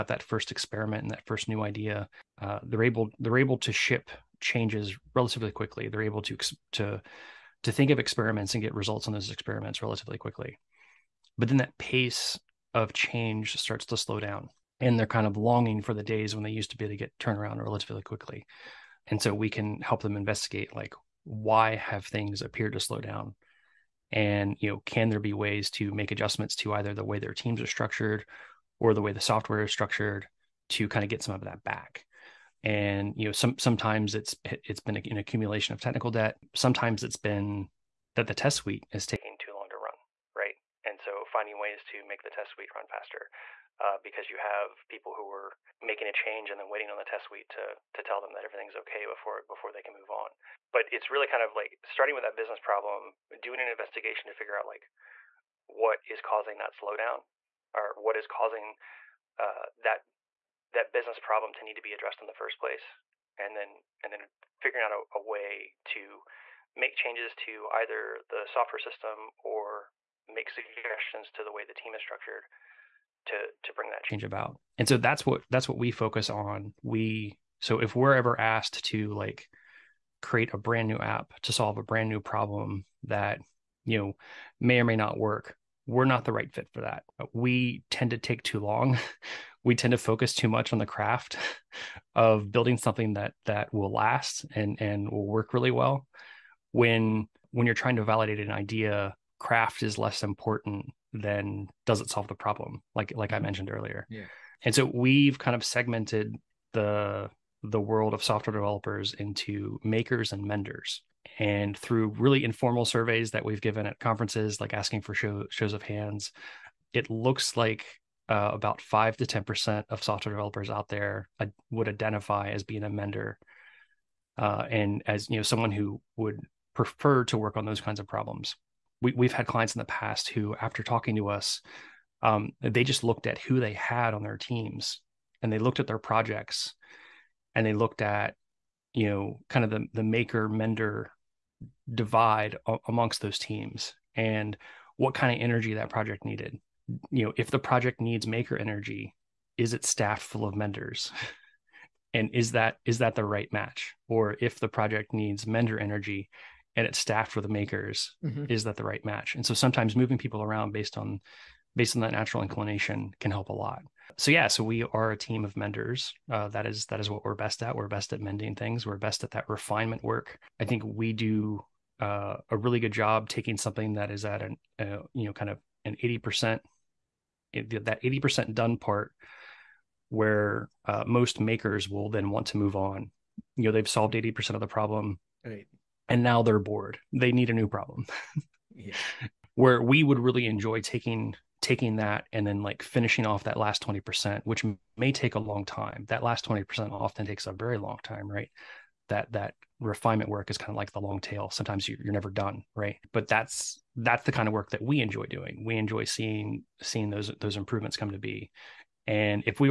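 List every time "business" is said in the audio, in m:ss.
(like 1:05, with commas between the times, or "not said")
0:52, 1:00.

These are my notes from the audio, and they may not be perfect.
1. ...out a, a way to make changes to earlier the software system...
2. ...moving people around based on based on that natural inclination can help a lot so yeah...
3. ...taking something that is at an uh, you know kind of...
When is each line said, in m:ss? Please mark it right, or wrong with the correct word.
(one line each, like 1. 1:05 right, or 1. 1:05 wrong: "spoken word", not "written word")
1. 1:04 wrong: "either", not "earlier"
2. 2:39 right
3. 2:53 right.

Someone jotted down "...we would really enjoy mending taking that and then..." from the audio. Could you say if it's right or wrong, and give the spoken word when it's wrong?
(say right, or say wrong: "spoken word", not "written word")
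wrong: "taking", not "mending".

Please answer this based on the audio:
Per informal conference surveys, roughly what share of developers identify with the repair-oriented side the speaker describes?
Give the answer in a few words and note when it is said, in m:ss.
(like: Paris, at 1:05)
5 to 10%, at 1:58.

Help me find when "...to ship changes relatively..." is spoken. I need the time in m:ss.
0:03.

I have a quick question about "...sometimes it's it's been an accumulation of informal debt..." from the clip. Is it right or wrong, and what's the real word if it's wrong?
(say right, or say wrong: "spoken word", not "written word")
wrong: "technical", not "informal".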